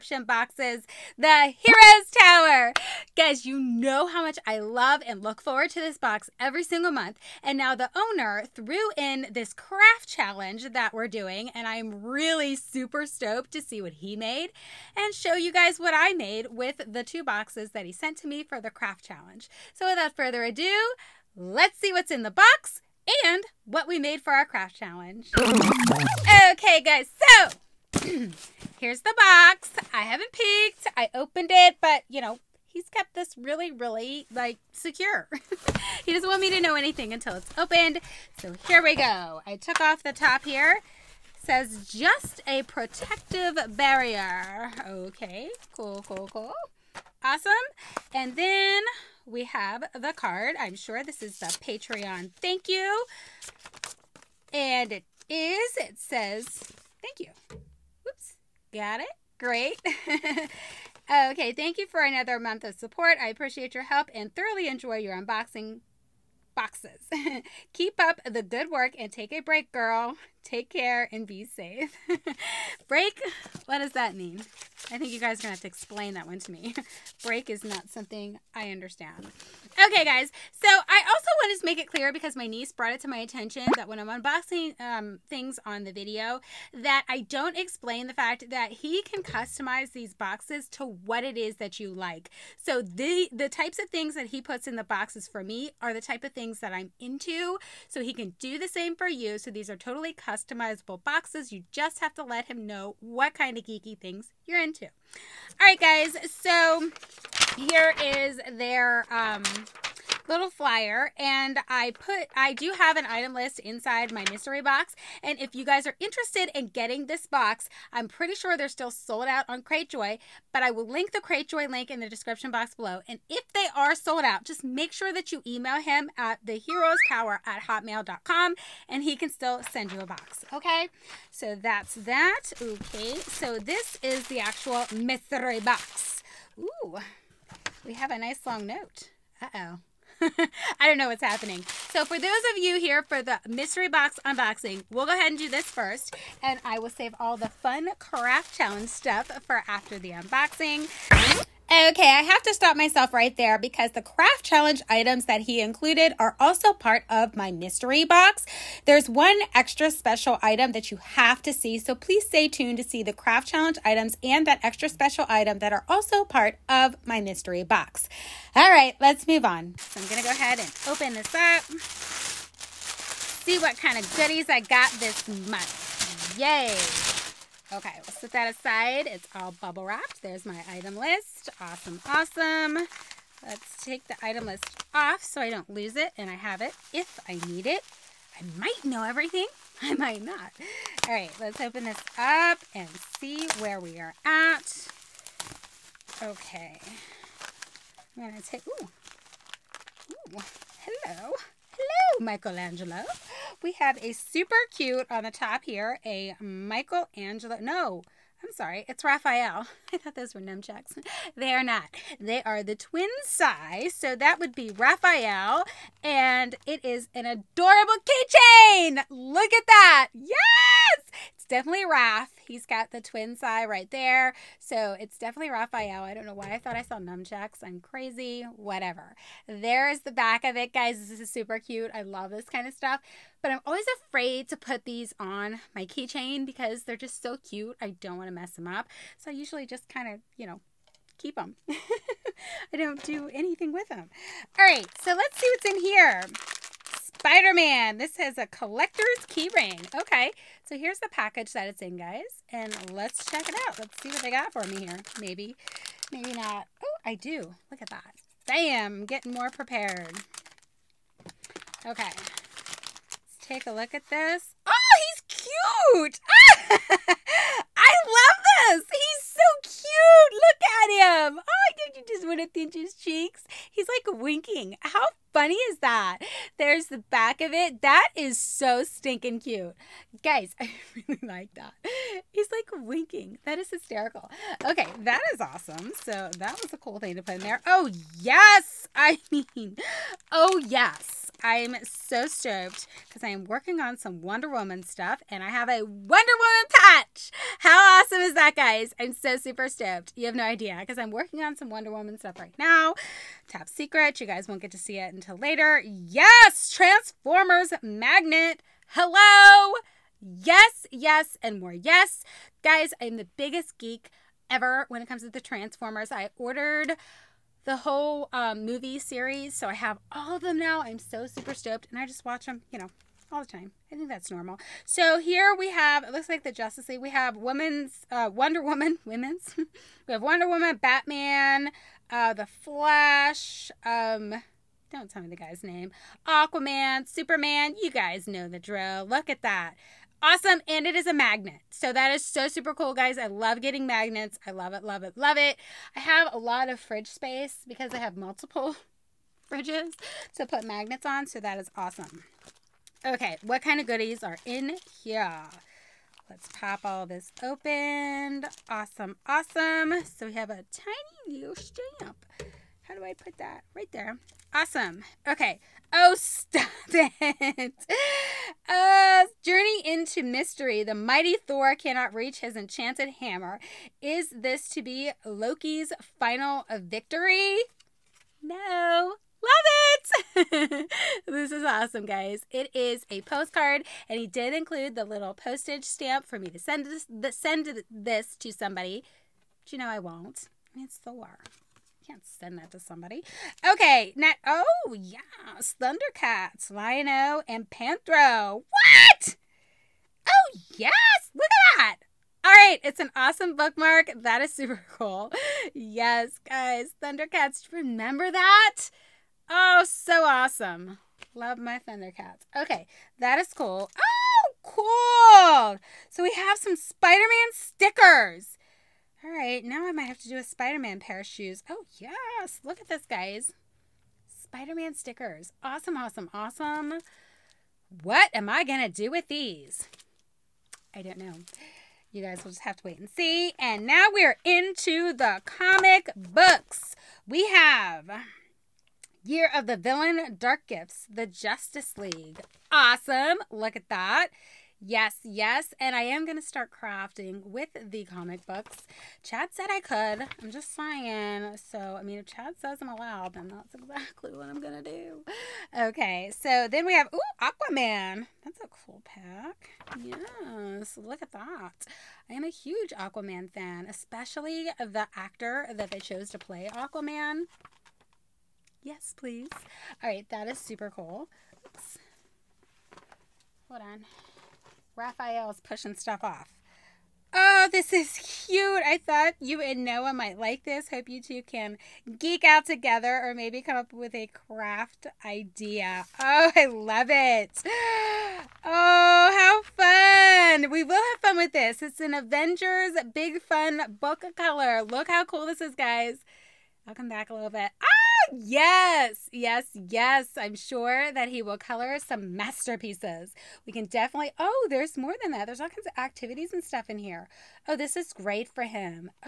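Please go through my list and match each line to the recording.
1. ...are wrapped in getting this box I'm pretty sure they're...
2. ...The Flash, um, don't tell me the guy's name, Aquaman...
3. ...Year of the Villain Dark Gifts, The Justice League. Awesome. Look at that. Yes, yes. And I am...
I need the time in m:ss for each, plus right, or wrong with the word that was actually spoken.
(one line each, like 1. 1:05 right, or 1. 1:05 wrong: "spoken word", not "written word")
1. 1:55 wrong: "interested", not "wrapped"
2. 5:32 right
3. 7:19 right.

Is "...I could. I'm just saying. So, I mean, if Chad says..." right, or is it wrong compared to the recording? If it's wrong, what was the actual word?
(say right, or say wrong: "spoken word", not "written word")
right.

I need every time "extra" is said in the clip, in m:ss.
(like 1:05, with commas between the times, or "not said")
2:39, 2:44.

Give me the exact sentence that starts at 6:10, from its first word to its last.
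The mighty Thor cannot reach his enchanted hammer.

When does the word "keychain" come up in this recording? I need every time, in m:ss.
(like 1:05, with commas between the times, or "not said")
3:38, 3:55.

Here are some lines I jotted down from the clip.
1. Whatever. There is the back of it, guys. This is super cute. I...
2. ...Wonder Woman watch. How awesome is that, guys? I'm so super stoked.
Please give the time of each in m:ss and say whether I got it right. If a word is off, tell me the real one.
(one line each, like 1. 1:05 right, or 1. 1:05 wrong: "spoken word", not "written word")
1. 3:48 right
2. 4:55 wrong: "patch", not "watch".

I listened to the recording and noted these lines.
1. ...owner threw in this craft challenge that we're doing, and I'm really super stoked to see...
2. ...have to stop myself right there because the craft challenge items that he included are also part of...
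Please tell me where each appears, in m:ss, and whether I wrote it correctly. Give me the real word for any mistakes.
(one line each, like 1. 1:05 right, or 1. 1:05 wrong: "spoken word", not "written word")
1. 0:07 right
2. 2:32 right.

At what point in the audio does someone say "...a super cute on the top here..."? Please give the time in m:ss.
3:24.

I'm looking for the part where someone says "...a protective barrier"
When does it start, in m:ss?
0:42.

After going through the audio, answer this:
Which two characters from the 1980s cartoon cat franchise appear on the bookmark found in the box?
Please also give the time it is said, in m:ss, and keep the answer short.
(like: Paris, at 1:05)
Lion-O and Panthro, at 6:36.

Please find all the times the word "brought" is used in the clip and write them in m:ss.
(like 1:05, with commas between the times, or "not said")
1:22.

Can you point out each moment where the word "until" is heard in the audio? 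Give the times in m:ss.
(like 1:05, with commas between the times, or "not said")
0:37, 5:05.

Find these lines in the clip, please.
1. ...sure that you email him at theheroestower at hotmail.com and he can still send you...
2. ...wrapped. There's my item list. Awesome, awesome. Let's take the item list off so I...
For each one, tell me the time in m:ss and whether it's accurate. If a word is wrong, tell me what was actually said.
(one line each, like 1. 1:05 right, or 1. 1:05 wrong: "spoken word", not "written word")
1. 2:04 right
2. 2:59 right.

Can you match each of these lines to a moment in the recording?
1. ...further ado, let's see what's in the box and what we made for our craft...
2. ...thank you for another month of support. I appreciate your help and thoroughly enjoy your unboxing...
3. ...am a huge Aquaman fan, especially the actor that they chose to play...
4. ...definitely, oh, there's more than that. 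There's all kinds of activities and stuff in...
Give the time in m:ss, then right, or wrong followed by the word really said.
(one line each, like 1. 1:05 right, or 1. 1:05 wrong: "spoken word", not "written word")
1. 0:20 right
2. 1:01 right
3. 7:42 right
4. 8:23 right.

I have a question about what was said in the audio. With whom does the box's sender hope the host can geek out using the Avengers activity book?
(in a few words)
Noah.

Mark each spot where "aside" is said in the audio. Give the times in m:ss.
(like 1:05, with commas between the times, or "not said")
2:58.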